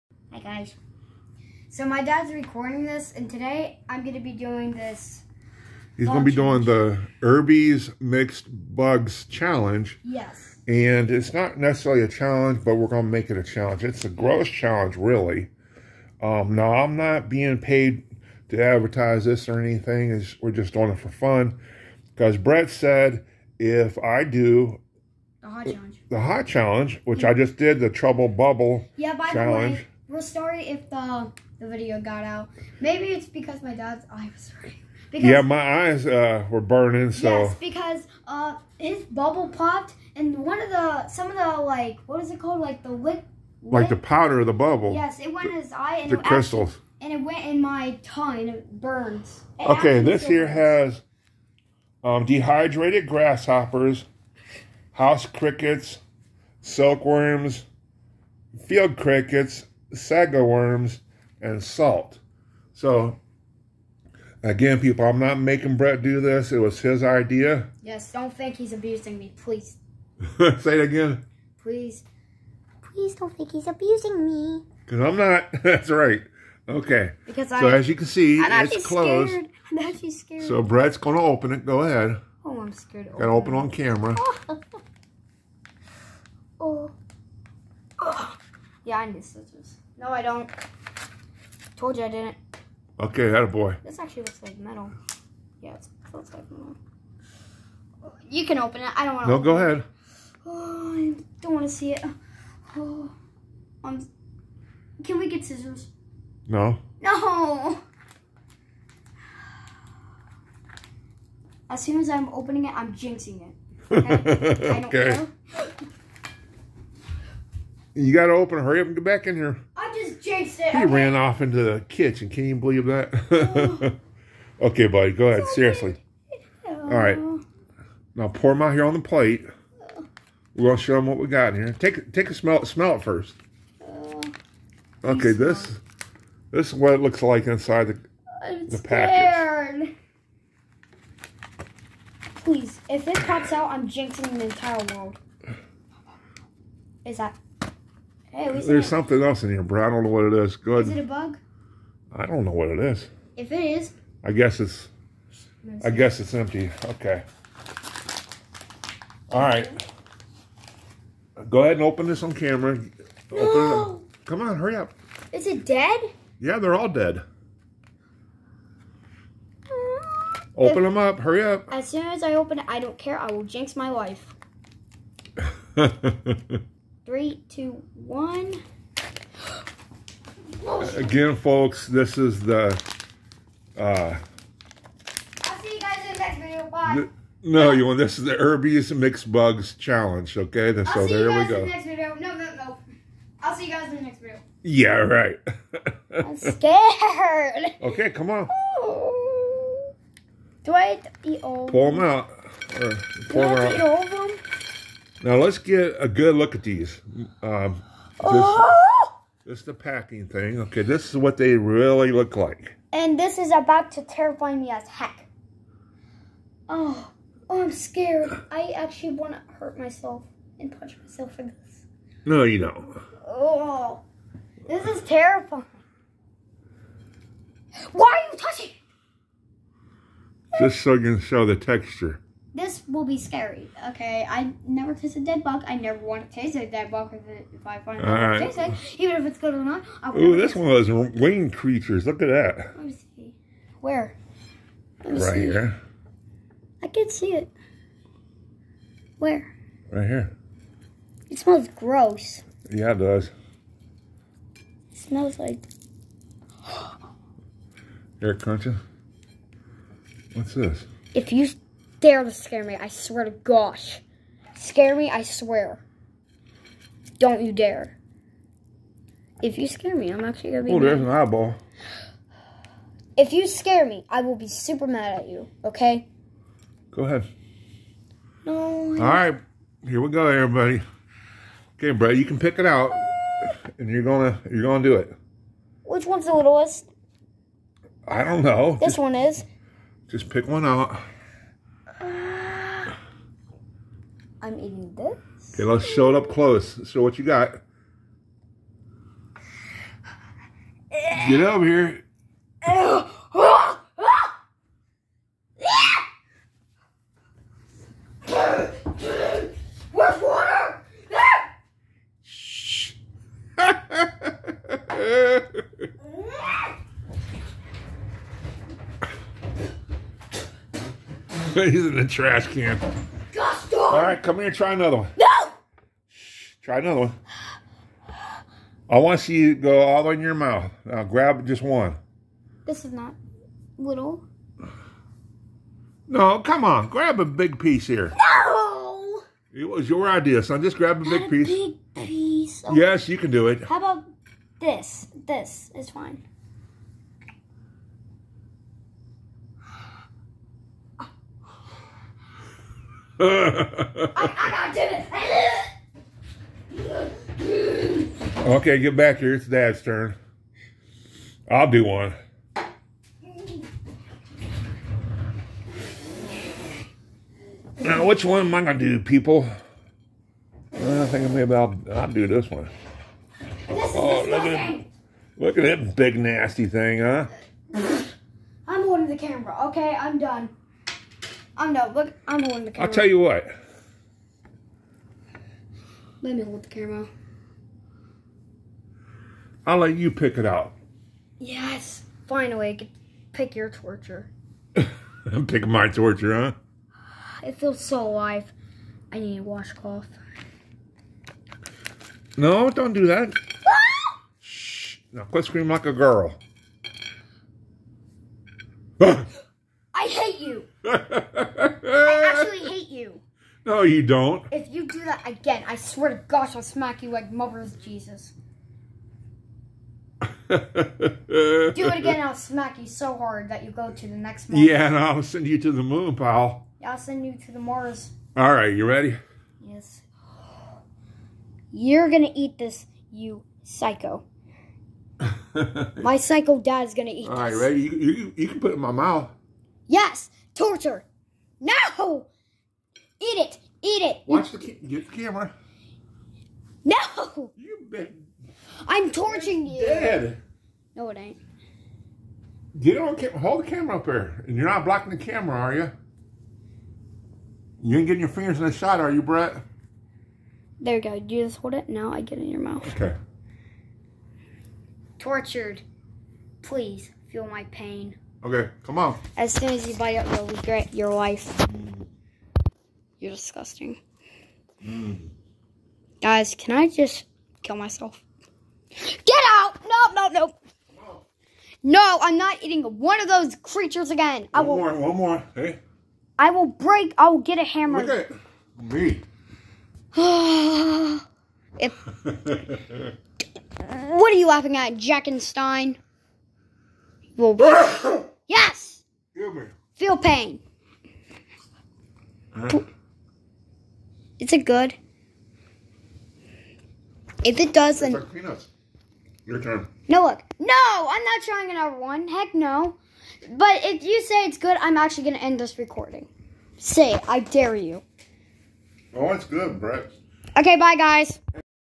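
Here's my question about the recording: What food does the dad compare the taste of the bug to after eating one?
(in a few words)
peanuts.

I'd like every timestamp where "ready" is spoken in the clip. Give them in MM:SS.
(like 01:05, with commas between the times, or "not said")
07:08, 07:17.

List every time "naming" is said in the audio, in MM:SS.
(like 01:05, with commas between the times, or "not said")
not said.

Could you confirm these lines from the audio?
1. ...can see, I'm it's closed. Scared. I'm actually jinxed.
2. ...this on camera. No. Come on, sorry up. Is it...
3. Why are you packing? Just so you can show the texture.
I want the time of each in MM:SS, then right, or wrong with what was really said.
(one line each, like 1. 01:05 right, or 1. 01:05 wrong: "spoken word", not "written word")
1. 01:17 wrong: "scared", not "jinxed"
2. 02:42 wrong: "hurry", not "sorry"
3. 03:47 wrong: "touching", not "packing".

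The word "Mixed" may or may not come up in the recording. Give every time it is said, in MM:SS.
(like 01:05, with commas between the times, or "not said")
00:07, 03:08.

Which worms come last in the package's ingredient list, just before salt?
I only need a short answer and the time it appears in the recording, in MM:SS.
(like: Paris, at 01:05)
sago worms, at 00:59.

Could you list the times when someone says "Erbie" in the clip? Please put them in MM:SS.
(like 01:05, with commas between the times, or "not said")
00:07, 03:08.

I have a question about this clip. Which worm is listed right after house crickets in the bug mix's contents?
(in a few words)
silkworms.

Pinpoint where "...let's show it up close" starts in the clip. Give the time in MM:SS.
04:55.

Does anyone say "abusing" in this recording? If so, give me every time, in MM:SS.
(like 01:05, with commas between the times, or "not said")
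01:08, 01:13.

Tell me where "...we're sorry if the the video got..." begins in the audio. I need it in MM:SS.
00:30.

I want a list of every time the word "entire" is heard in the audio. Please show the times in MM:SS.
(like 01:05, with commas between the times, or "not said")
02:24.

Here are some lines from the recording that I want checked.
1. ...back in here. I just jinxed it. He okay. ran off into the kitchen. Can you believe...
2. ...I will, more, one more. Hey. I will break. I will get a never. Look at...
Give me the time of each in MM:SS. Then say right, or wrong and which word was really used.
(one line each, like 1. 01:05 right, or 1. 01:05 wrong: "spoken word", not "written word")
1. 01:59 right
2. 08:04 wrong: "hammer", not "never".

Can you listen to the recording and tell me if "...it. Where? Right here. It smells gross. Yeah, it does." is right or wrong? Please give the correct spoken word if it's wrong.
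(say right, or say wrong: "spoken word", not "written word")
right.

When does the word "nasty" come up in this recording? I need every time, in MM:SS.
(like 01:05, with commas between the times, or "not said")
06:16.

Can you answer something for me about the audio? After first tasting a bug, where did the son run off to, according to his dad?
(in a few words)
the trash can.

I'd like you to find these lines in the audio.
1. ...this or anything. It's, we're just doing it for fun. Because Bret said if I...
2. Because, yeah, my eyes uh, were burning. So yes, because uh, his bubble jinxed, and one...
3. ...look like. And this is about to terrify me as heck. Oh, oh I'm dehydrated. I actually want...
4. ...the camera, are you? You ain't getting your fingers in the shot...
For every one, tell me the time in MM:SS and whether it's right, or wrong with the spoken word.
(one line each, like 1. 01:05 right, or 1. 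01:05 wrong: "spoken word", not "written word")
1. 00:19 right
2. 00:35 wrong: "popped", not "jinxed"
3. 03:32 wrong: "scared", not "dehydrated"
4. 07:35 right.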